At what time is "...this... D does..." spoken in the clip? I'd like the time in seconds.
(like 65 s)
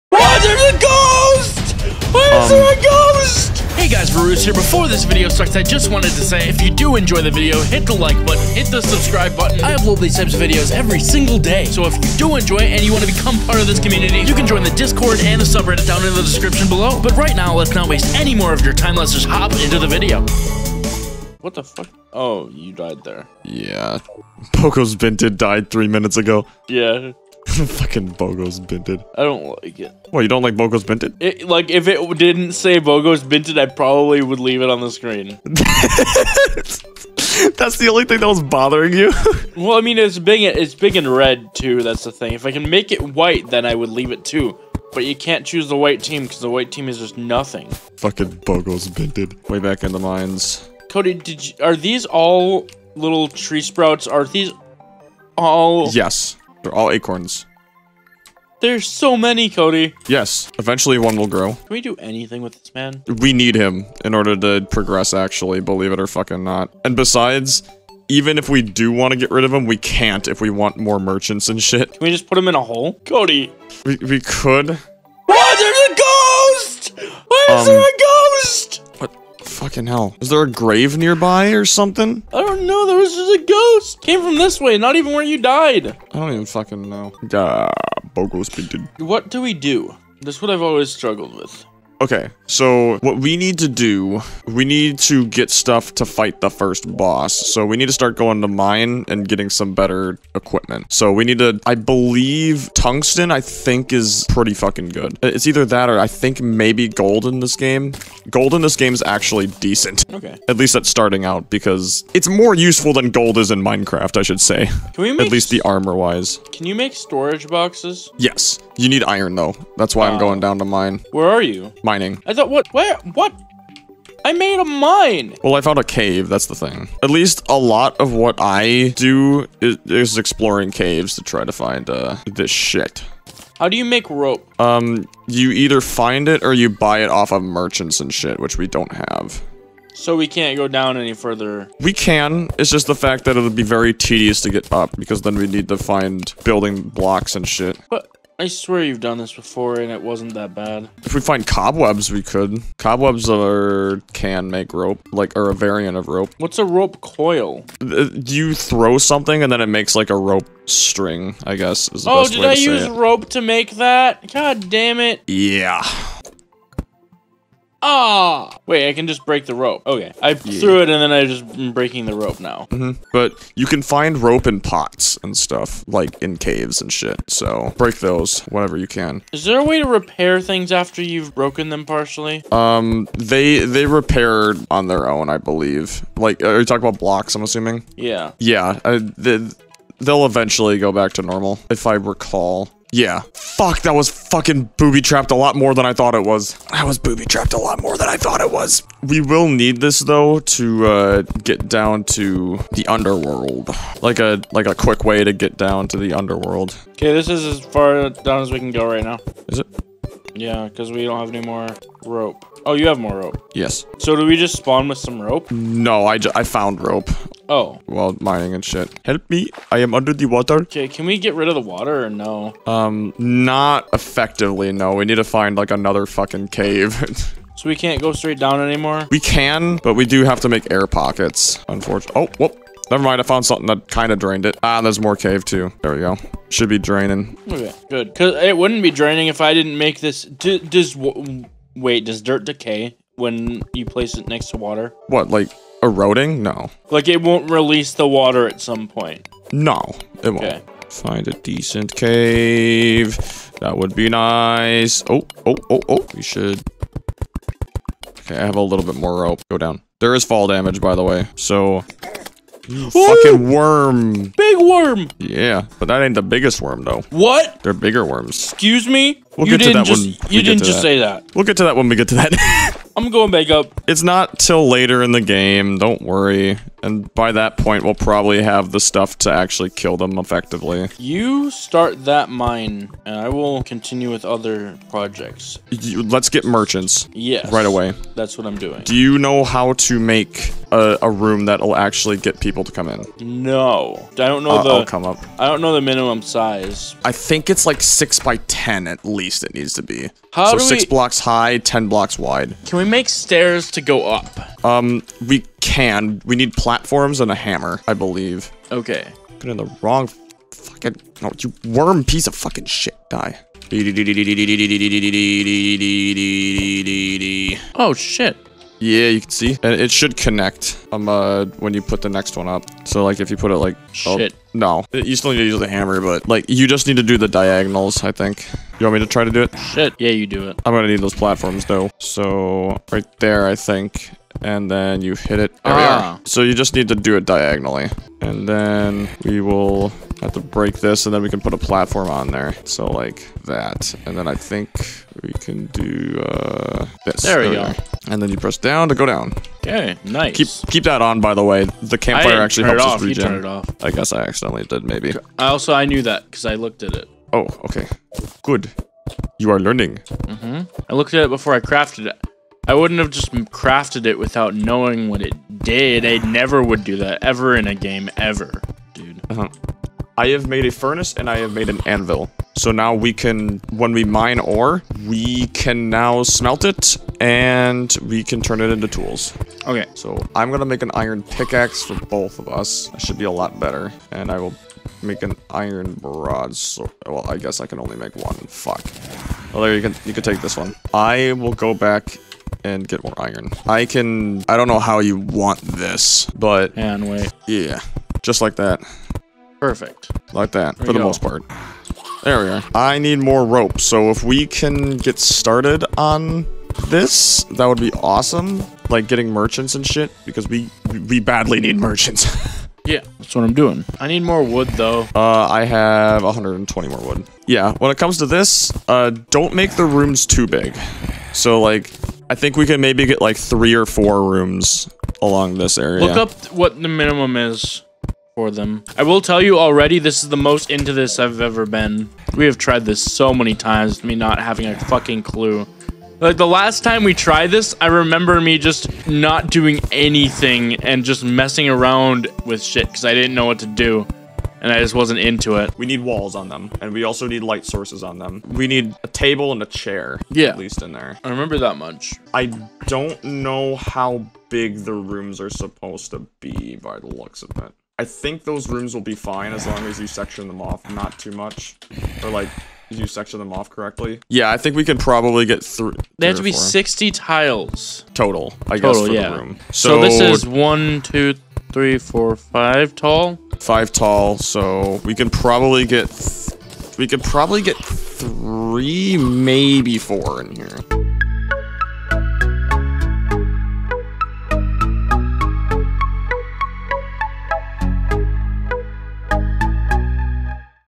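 239 s.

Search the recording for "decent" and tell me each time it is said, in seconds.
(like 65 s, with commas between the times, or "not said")
109 s, 251 s.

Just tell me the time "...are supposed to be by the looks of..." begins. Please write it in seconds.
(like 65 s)
455 s.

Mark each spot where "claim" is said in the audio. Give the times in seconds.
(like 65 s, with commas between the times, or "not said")
not said.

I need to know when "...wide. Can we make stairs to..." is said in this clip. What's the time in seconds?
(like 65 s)
302 s.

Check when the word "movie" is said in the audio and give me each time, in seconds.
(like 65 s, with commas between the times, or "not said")
not said.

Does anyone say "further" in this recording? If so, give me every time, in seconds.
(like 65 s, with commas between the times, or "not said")
141 s.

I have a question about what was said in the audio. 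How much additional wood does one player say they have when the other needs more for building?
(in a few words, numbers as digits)
120.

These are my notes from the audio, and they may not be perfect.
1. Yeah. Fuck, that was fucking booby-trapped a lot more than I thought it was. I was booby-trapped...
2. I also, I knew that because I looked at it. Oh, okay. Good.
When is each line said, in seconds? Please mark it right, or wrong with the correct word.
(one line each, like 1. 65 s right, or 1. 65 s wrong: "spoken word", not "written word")
1. 192 s right
2. 355 s right.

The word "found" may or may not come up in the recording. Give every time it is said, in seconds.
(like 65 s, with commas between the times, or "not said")
125 s, 216 s, 233 s.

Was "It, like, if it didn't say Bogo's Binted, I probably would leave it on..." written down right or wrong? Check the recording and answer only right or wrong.
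right.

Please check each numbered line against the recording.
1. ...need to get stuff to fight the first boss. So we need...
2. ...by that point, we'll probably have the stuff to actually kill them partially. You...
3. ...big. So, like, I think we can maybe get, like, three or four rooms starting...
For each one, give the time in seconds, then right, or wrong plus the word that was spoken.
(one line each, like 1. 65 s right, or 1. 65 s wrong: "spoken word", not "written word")
1. 94 s right
2. 277 s wrong: "effectively", not "partially"
3. 420 s wrong: "along", not "starting".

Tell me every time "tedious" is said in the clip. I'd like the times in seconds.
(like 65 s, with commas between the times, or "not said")
143 s.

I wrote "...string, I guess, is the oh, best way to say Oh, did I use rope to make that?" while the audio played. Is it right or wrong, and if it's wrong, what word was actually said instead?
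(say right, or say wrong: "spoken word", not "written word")
right.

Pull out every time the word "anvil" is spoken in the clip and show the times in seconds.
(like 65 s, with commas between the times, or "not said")
371 s.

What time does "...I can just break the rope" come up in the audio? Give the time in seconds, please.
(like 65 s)
168 s.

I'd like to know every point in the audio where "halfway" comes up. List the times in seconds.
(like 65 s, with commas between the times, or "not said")
not said.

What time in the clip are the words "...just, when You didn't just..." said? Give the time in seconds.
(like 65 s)
269 s.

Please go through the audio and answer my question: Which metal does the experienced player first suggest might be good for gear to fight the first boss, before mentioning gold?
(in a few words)
Tungsten.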